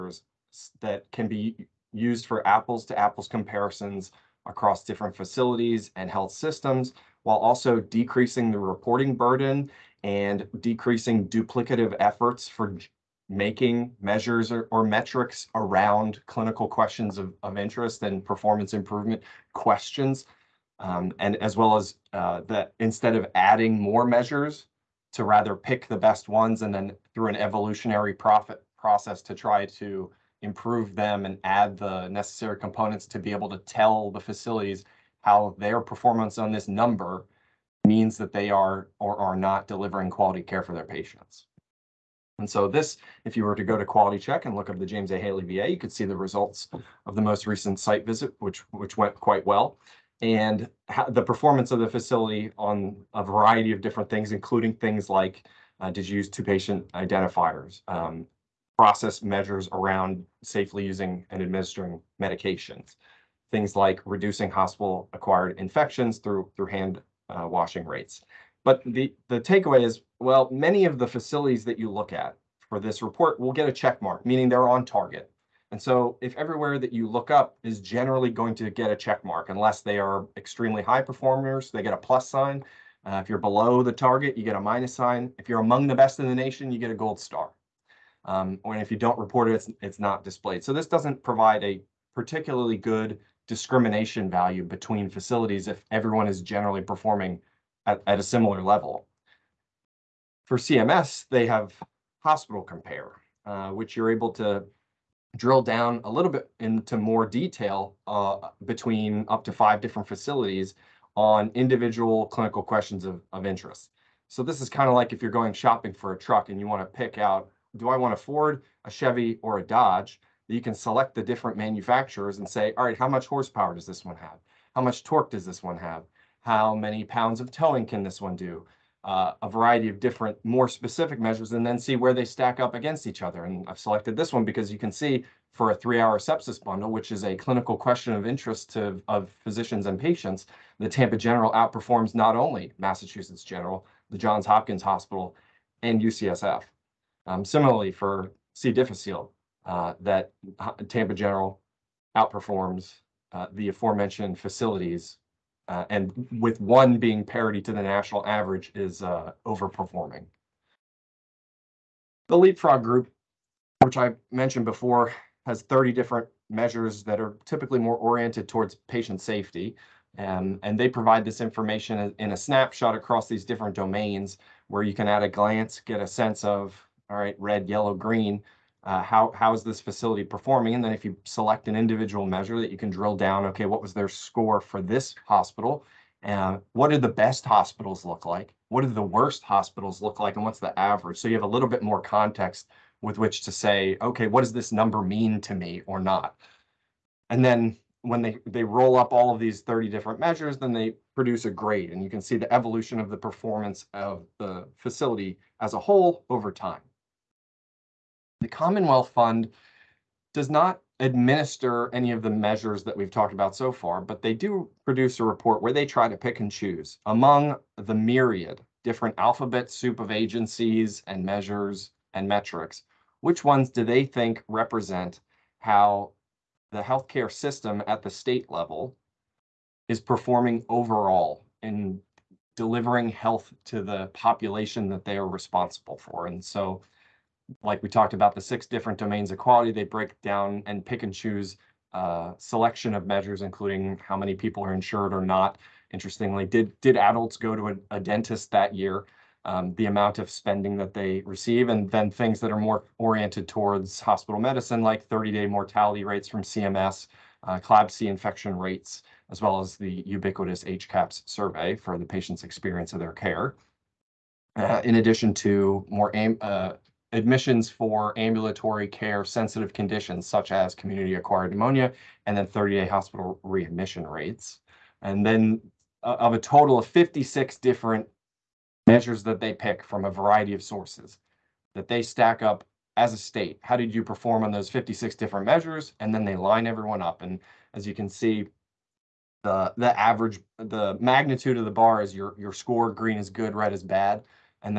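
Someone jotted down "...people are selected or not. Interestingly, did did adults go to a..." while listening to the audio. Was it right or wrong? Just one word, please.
wrong.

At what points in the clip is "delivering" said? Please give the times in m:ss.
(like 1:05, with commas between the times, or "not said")
0:39, 3:52.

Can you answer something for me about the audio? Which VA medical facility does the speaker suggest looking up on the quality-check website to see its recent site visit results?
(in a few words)
James A. Haley VA.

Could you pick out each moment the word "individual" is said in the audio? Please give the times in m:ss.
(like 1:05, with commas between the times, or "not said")
1:51, 3:01.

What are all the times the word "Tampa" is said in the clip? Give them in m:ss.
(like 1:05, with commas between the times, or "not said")
2:20, 2:30.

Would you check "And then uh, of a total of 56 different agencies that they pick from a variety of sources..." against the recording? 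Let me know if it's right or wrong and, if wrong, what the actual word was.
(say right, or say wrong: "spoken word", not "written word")
wrong: "measures", not "agencies".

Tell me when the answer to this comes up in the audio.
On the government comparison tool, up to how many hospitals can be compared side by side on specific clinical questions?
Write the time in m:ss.
1:49.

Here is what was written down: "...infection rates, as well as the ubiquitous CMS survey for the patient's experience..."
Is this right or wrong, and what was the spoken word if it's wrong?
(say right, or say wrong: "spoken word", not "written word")
wrong: "HCAHPS", not "CMS".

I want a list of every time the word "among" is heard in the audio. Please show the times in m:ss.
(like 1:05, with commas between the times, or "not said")
1:25, 3:37.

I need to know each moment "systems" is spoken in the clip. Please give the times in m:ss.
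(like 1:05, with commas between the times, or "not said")
0:06, 3:47.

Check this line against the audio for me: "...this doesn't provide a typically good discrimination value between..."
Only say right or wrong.
wrong.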